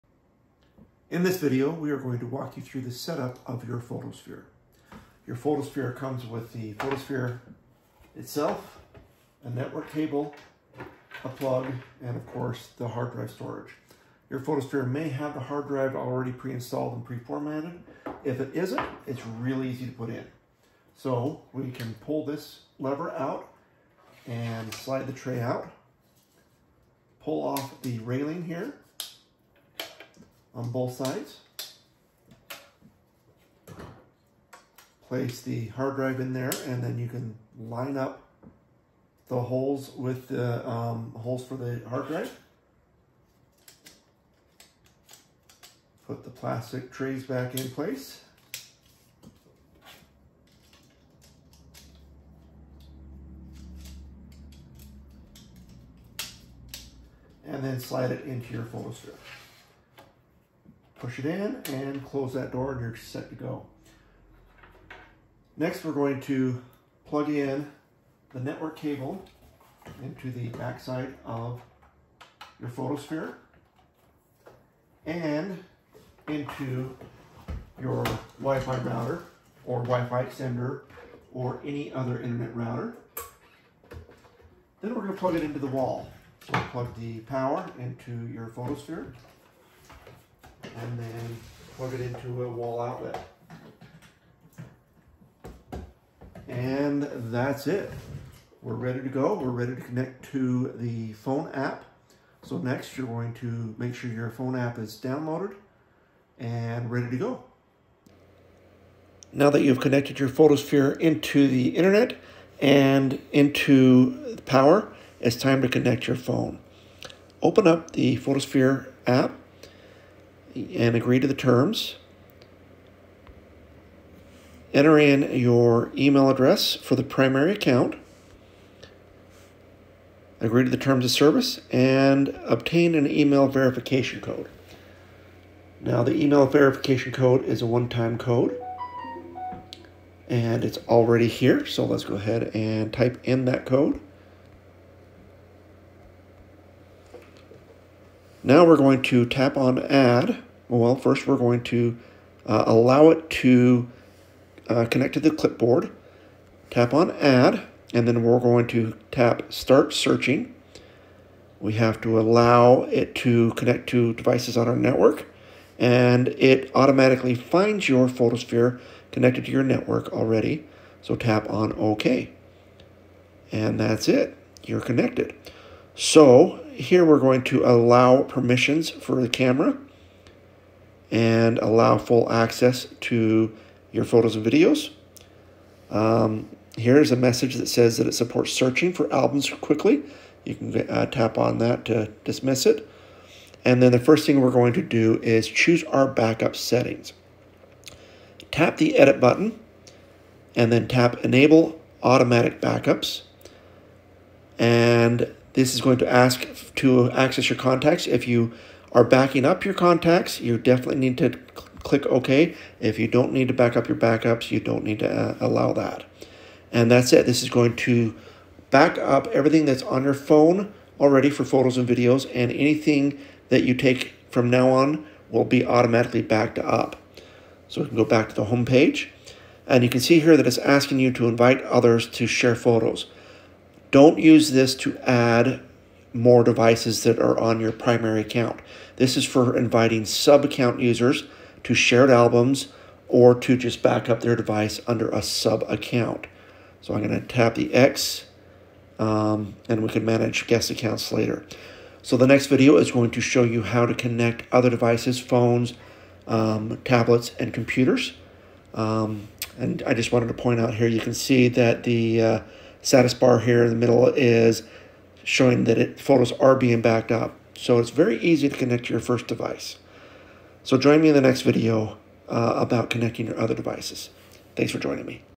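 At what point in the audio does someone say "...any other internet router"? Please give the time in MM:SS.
01:21.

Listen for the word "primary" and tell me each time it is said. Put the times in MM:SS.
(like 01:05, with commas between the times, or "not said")
02:07, 03:57.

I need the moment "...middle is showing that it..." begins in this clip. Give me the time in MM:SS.
04:23.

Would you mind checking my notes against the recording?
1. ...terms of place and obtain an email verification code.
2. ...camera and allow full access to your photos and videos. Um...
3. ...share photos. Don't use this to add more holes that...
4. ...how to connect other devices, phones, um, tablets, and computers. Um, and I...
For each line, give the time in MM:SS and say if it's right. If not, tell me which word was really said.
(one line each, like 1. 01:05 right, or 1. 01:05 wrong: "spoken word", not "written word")
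1. 02:10 wrong: "service", not "place"
2. 02:59 right
3. 03:52 wrong: "devices", not "holes"
4. 04:13 right.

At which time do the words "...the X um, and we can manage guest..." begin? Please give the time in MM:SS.
04:07.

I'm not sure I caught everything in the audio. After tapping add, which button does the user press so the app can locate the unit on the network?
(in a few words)
start searching.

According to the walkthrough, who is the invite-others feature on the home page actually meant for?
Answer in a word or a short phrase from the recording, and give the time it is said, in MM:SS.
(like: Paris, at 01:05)
sub-account users, at 04:00.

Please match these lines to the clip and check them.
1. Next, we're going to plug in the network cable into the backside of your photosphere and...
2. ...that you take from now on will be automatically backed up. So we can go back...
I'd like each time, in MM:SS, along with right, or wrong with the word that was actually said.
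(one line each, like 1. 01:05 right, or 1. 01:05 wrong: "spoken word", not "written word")
1. 01:05 right
2. 03:43 right.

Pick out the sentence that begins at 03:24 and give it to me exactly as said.
And this is going to ask to access your contacts.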